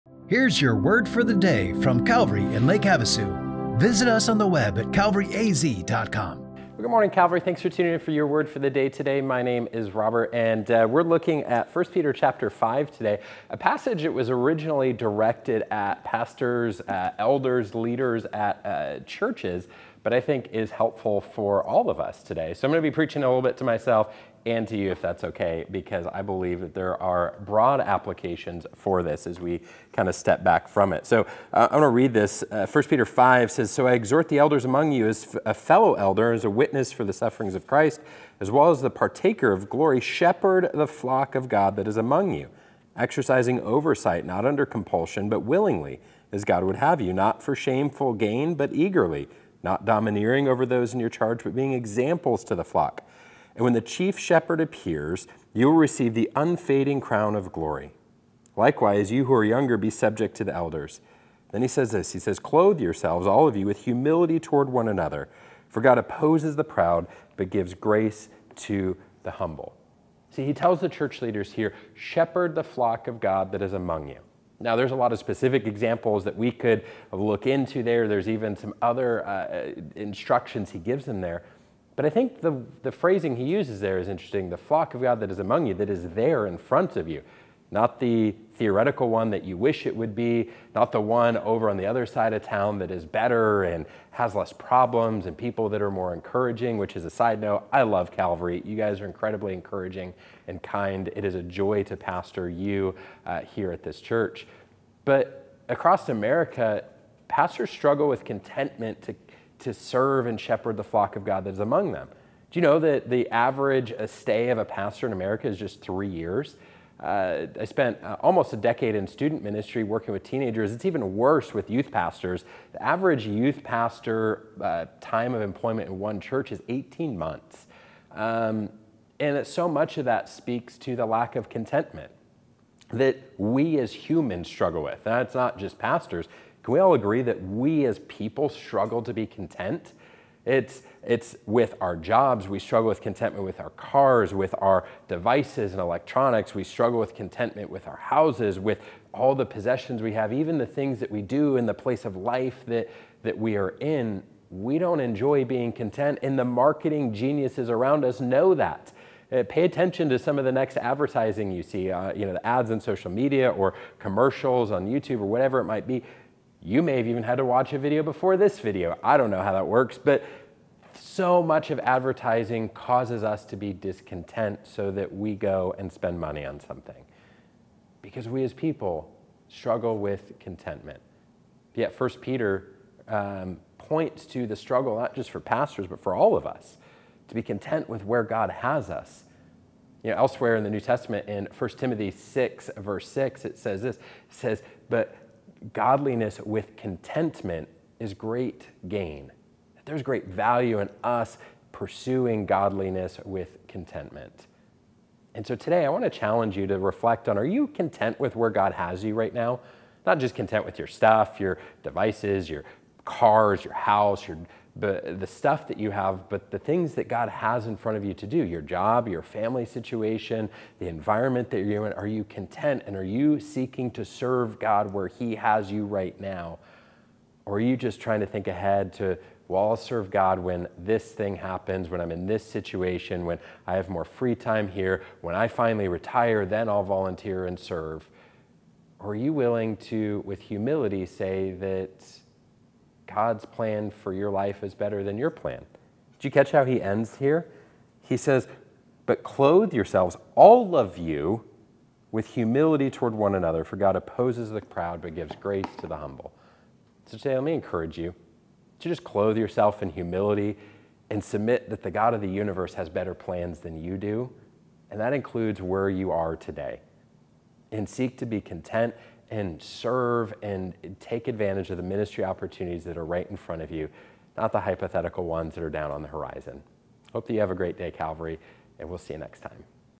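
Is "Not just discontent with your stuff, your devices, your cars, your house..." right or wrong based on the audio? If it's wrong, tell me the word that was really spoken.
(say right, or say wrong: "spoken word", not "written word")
wrong: "content", not "discontent".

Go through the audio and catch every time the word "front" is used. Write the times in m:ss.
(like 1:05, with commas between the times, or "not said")
1:26, 3:37, 4:33.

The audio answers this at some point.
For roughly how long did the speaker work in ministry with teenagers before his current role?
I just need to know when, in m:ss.
1:58.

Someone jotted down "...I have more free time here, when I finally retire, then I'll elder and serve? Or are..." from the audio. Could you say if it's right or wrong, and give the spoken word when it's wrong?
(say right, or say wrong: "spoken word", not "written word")
wrong: "volunteer", not "elder".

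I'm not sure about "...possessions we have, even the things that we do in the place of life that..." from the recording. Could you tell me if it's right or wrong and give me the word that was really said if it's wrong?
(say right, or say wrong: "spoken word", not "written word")
right.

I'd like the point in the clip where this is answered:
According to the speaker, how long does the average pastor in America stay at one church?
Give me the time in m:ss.
1:55.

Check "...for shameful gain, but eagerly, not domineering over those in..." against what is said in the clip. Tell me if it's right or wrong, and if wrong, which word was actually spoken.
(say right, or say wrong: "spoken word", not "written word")
right.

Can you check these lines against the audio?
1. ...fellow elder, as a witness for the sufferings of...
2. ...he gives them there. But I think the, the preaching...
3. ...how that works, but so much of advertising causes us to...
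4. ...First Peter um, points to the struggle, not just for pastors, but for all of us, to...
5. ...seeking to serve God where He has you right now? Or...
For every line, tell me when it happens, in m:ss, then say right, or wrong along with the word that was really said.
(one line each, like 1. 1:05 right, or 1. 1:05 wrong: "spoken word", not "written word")
1. 0:35 right
2. 1:20 wrong: "phrasing", not "preaching"
3. 2:49 right
4. 3:01 right
5. 3:43 right.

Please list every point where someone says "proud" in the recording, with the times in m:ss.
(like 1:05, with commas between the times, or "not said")
1:06, 4:14.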